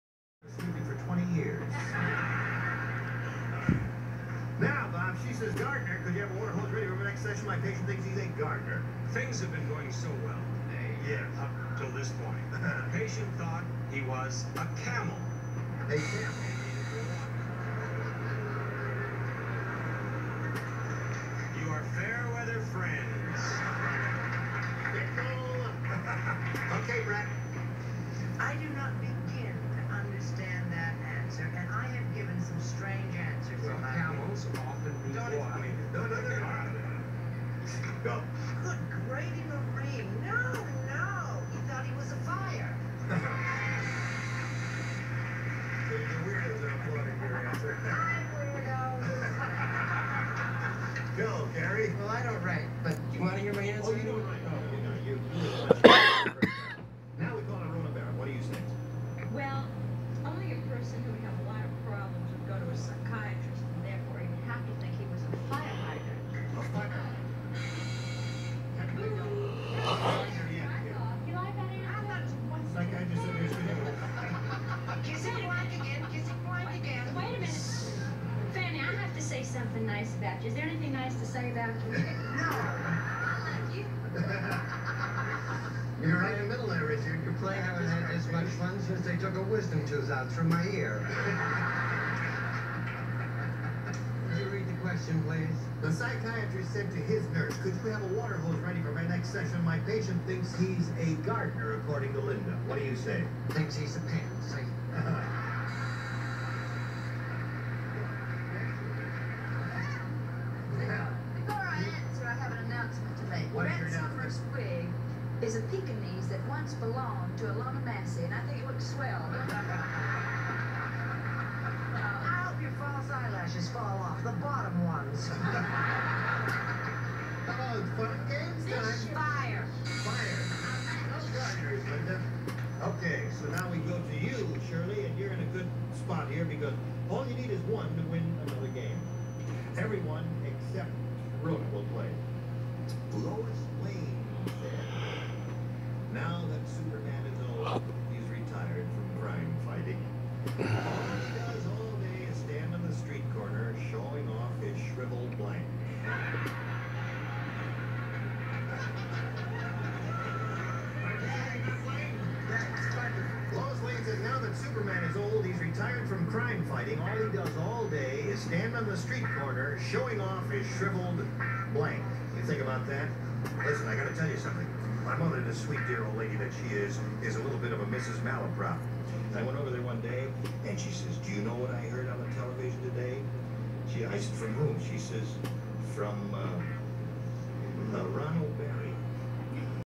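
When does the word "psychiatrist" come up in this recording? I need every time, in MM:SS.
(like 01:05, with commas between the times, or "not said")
01:35.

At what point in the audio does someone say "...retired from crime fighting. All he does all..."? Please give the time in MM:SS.
02:45.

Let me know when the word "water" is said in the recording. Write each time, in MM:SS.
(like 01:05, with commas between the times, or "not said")
00:06, 01:38.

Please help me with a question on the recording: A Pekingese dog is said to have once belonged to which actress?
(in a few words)
Ilona Massey.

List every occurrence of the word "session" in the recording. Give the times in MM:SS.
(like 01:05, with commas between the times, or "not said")
00:07, 01:39.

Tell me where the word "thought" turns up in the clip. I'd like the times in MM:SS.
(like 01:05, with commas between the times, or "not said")
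00:13, 00:41.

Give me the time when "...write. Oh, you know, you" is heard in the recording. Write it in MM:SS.
00:54.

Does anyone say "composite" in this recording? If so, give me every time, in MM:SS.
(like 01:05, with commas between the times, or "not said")
not said.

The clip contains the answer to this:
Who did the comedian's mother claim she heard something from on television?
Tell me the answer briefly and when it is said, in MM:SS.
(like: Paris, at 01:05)
Ron O'Barry, at 03:08.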